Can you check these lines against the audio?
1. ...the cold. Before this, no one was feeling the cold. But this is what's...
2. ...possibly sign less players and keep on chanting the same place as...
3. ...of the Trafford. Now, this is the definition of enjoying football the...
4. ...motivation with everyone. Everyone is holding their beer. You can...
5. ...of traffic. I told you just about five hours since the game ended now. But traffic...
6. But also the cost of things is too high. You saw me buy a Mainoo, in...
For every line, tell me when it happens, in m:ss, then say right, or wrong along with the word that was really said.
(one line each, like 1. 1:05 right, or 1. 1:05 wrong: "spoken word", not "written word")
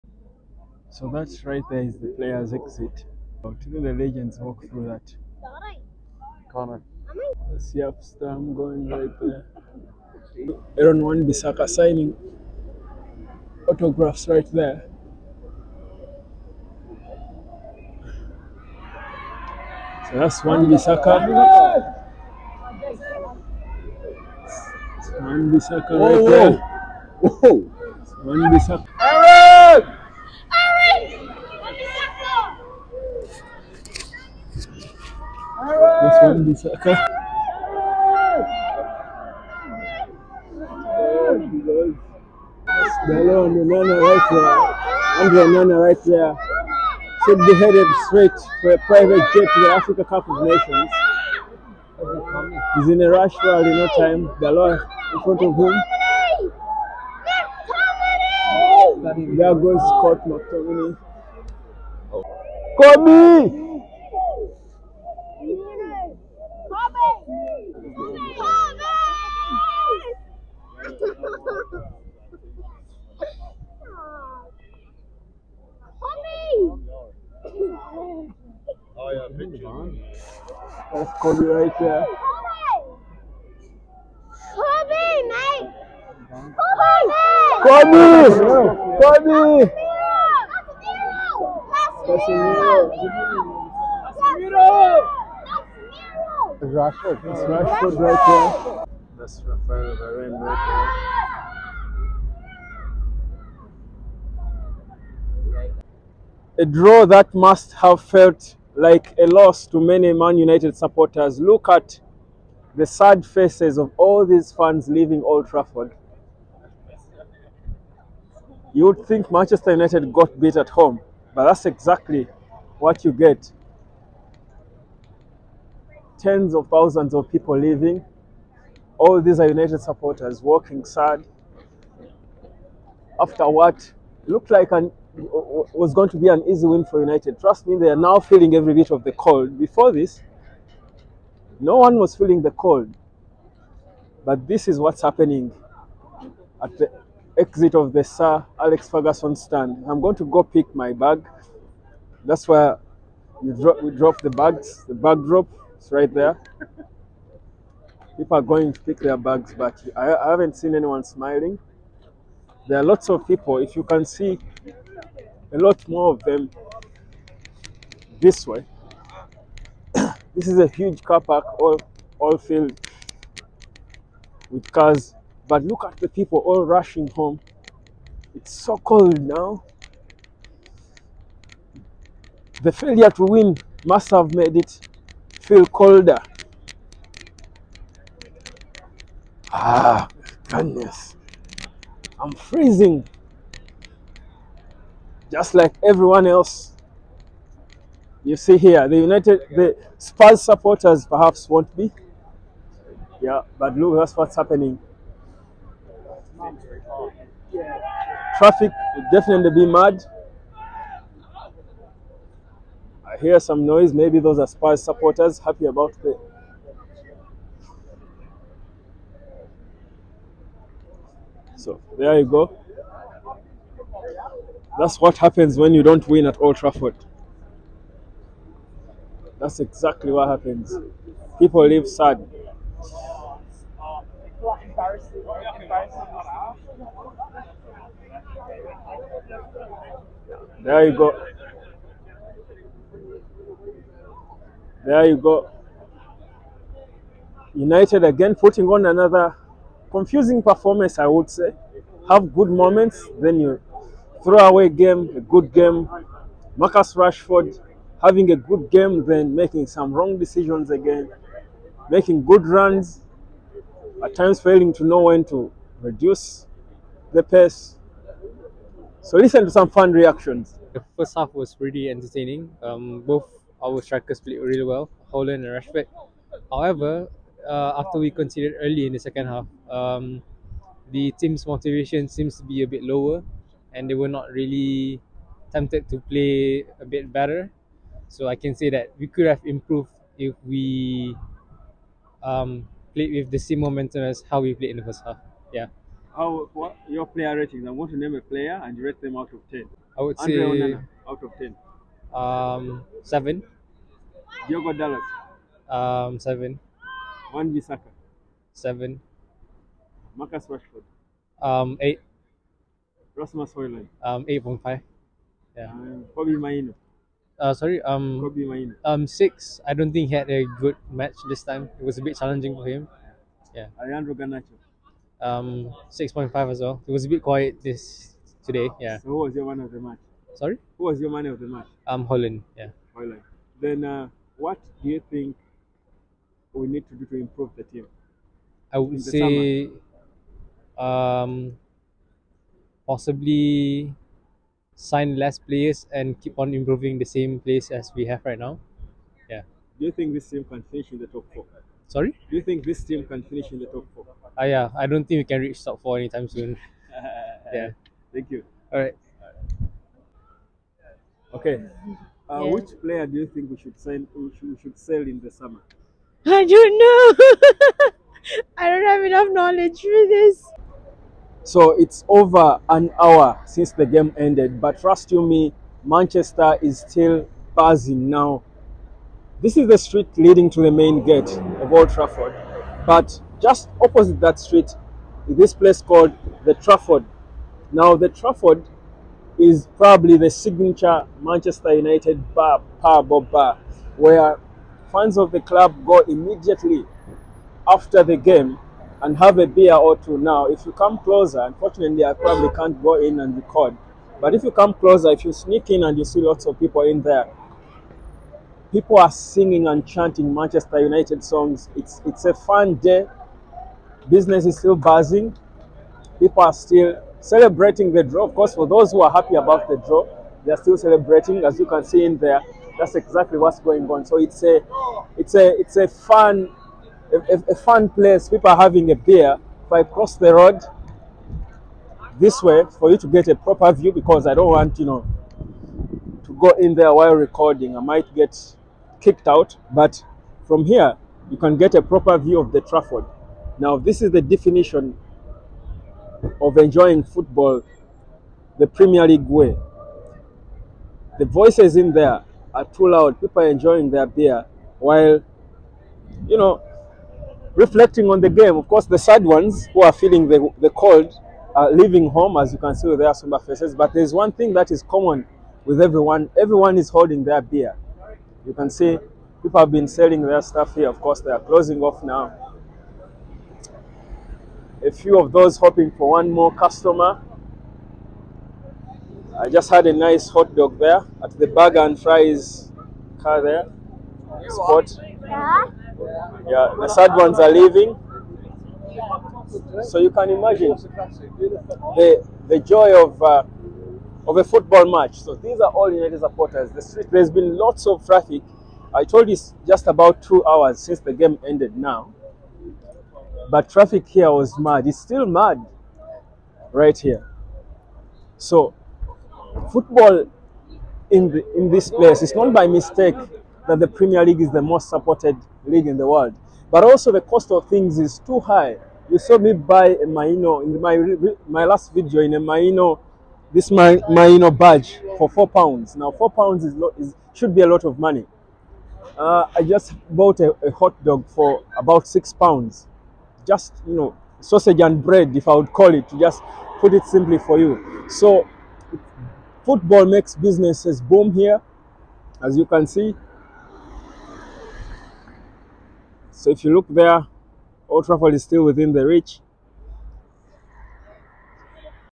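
1. 2:19 right
2. 5:42 wrong: "improving", not "chanting"
3. 7:22 right
4. 7:44 wrong: "common", not "motivation"
5. 8:17 wrong: "two", not "five"
6. 8:36 right.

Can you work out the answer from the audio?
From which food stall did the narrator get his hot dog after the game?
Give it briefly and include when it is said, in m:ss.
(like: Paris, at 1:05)
Burger and Fries, at 8:01.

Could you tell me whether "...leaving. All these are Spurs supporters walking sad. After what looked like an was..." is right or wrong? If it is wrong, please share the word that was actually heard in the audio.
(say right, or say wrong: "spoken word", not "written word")
wrong: "United", not "Spurs".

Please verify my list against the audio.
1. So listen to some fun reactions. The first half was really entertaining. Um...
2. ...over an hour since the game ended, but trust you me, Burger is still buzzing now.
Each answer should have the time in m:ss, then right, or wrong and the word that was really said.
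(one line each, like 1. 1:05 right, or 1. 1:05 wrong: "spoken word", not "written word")
1. 4:29 right
2. 6:12 wrong: "Manchester", not "Burger".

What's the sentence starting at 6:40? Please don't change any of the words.
Now, if you come closer, unfortunately, I probably can't go in and record.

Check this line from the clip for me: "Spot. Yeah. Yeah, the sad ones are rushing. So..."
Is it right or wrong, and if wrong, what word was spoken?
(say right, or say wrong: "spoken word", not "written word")
wrong: "leaving", not "rushing".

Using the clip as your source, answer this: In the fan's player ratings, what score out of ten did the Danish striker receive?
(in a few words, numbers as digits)
8.5.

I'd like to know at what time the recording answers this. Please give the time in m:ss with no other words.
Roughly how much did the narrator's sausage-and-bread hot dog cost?
8:52.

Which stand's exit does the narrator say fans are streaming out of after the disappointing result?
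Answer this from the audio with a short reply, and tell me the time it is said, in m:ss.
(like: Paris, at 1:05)
Sir Alex Ferguson stand, at 2:28.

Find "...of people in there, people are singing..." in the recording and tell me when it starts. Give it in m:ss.
6:46.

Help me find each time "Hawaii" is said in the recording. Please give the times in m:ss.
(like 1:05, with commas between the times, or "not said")
not said.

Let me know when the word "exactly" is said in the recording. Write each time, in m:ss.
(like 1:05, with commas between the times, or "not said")
2:01, 3:49, 7:02.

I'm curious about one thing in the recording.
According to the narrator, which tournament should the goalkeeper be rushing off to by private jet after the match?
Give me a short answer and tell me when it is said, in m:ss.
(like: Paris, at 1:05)
Africa Cup of Nations, at 0:49.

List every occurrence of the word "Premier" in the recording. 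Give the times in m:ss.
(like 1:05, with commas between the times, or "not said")
7:28, 8:33.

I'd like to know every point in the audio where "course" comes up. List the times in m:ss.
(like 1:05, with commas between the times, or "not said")
6:58, 7:38, 7:51.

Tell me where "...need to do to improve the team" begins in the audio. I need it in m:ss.
5:36.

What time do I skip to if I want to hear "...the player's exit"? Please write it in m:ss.
0:01.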